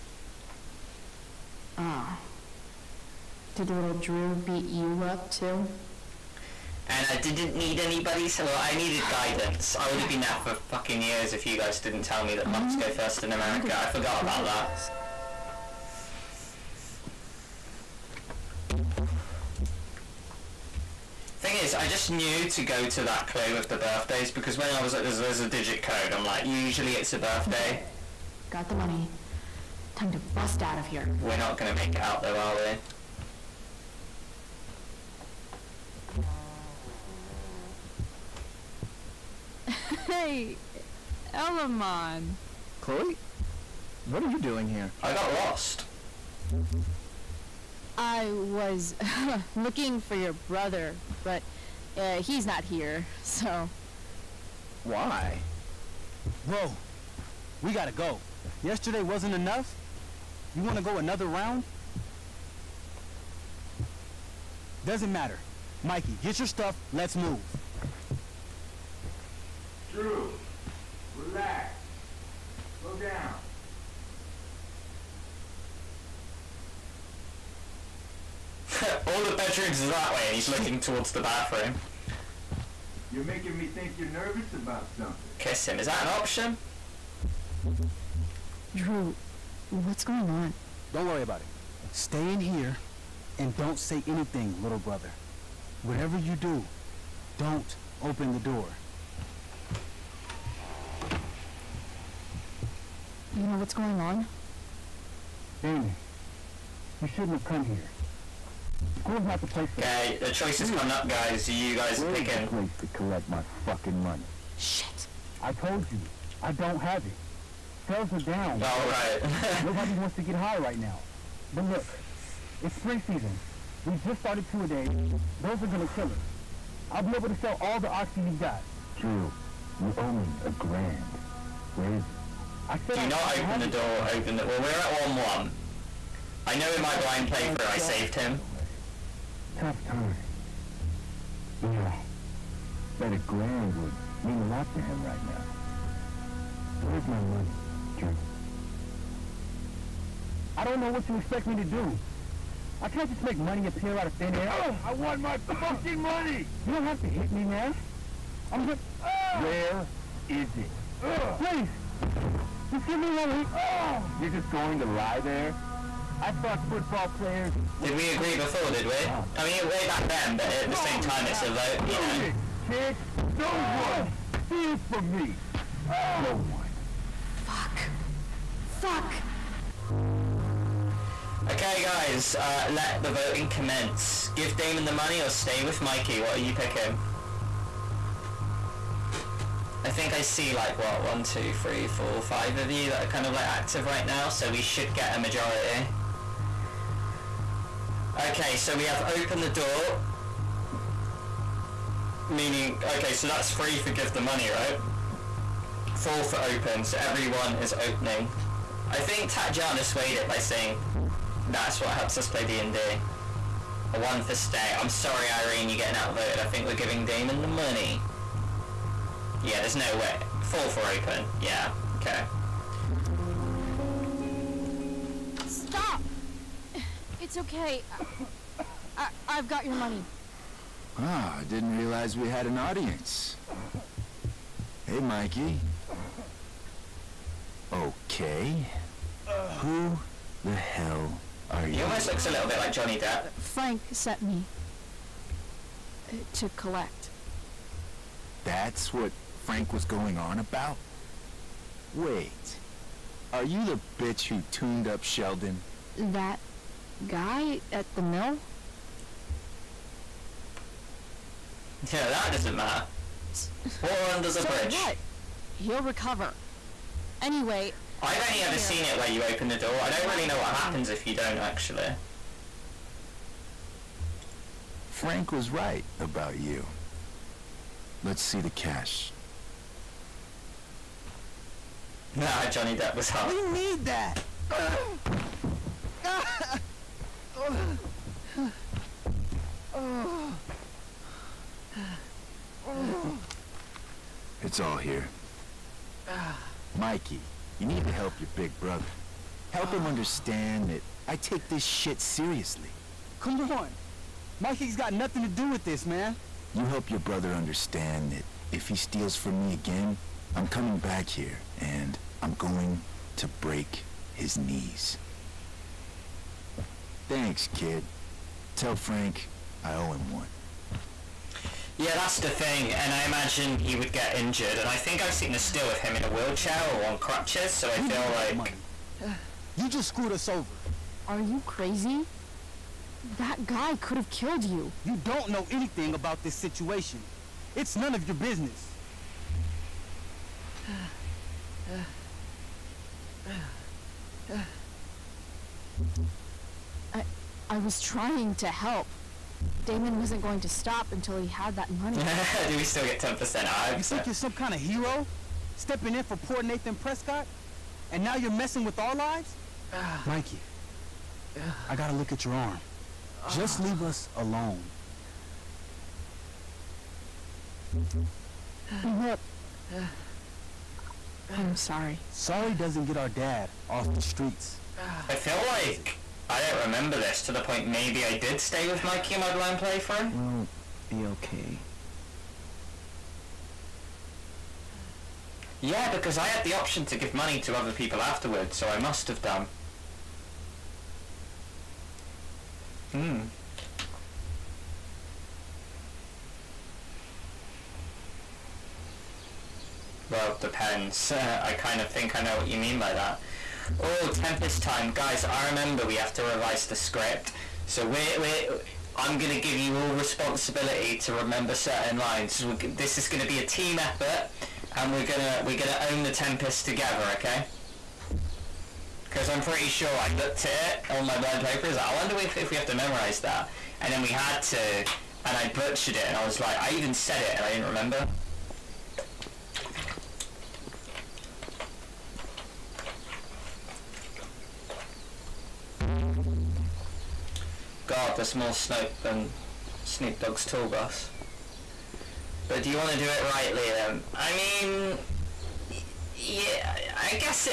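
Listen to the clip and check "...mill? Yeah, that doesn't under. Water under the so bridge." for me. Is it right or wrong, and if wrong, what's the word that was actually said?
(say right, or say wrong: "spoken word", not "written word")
wrong: "matter", not "under".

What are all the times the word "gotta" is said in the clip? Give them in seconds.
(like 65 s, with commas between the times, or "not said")
57 s, 361 s.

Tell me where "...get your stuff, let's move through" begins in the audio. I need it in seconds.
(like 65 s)
66 s.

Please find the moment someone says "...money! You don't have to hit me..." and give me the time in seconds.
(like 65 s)
155 s.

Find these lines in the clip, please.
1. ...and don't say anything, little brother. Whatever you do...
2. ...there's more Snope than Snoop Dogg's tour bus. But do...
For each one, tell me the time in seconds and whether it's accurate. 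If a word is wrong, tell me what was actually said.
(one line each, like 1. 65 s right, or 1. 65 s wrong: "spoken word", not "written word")
1. 93 s right
2. 438 s right.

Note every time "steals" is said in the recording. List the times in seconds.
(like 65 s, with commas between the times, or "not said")
174 s, 308 s.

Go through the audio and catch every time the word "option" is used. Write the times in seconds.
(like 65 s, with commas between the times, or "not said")
86 s, 386 s.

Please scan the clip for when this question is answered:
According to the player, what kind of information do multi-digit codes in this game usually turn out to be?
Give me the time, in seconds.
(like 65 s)
26 s.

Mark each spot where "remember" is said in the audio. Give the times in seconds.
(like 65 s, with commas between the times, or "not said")
376 s, 405 s, 411 s, 427 s.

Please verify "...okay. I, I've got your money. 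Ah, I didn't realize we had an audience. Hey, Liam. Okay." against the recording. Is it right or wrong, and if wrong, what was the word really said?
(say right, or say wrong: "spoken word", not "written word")
wrong: "Mikey", not "Liam".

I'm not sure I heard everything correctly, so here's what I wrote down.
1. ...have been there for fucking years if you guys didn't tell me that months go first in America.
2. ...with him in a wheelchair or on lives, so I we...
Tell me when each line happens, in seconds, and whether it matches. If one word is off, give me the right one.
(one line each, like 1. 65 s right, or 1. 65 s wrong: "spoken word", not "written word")
1. 9 s right
2. 325 s wrong: "crutches", not "lives".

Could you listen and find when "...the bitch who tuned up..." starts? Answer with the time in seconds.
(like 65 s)
253 s.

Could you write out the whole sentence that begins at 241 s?
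He almost looks a little bit like Johnny Depp.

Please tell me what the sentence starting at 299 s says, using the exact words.
Help him understand that I take this shit seriously.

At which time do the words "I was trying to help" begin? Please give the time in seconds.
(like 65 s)
347 s.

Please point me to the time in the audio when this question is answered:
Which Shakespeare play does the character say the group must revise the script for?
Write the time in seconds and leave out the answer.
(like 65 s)
416 s.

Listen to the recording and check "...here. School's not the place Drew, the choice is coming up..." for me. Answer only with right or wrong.
wrong.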